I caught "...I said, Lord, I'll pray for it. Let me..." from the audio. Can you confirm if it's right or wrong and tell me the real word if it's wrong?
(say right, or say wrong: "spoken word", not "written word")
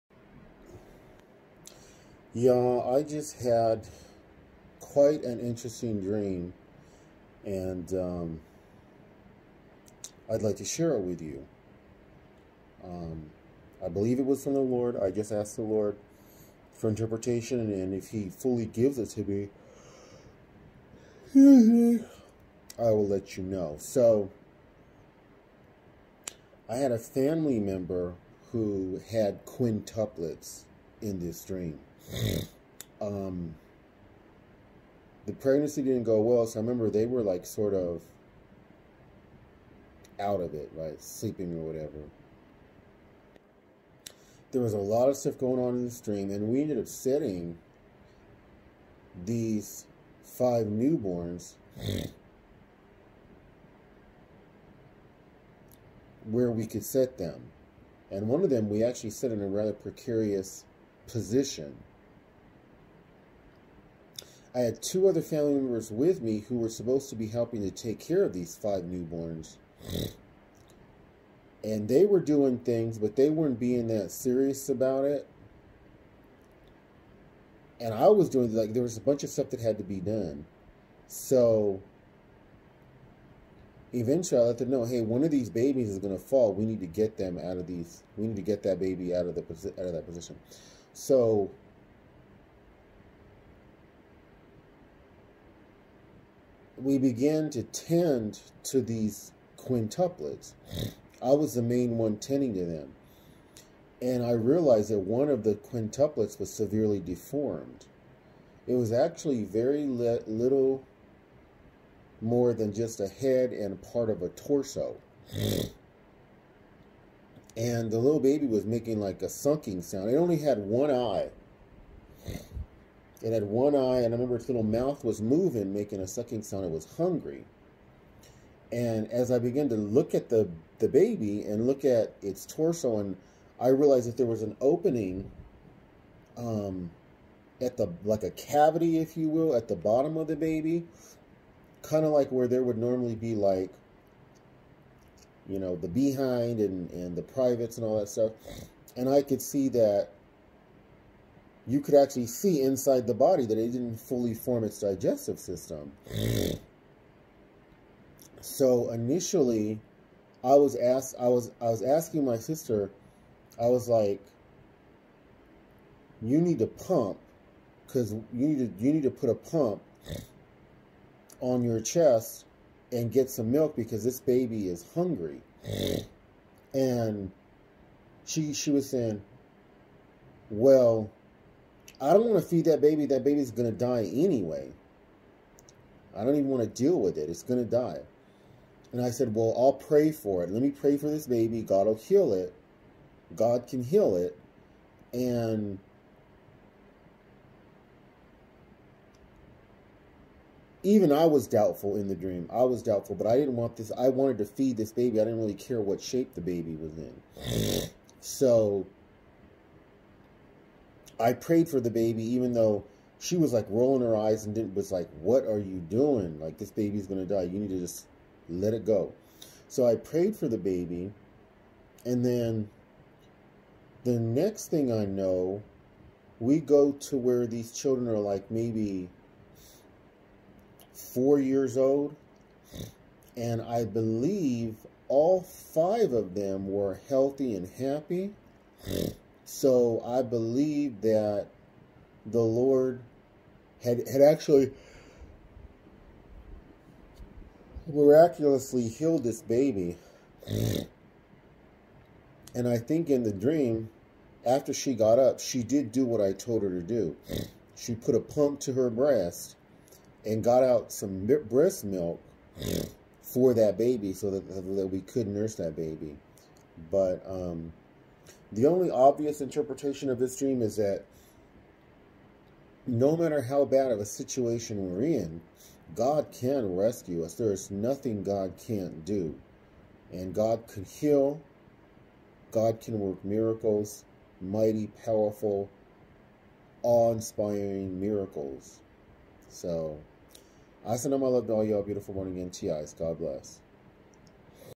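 wrong: "Well", not "Lord".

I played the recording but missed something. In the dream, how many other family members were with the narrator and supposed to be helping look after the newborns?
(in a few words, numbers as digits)
2.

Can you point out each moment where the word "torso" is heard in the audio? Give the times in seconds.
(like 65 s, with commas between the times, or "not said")
114 s, 132 s.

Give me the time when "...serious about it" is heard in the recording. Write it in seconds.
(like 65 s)
74 s.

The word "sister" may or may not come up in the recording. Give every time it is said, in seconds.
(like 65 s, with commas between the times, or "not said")
162 s.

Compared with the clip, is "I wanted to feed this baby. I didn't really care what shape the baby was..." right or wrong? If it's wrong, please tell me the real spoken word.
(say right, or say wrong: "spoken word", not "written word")
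right.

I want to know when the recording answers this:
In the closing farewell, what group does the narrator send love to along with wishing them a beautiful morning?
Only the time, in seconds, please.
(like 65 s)
292 s.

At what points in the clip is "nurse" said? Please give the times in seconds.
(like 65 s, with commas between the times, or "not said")
265 s.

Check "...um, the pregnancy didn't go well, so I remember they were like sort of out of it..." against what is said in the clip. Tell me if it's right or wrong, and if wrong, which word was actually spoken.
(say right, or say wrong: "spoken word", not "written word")
right.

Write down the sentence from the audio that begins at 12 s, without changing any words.
Um, I believe it was from the Lord.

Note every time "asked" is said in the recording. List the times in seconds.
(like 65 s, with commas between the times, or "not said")
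15 s, 160 s.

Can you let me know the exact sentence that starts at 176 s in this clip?
and she, she was saying, well, I don't want to feed that baby.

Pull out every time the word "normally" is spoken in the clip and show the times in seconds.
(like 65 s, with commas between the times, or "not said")
142 s.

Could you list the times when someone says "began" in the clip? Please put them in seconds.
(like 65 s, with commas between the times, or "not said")
96 s, 129 s.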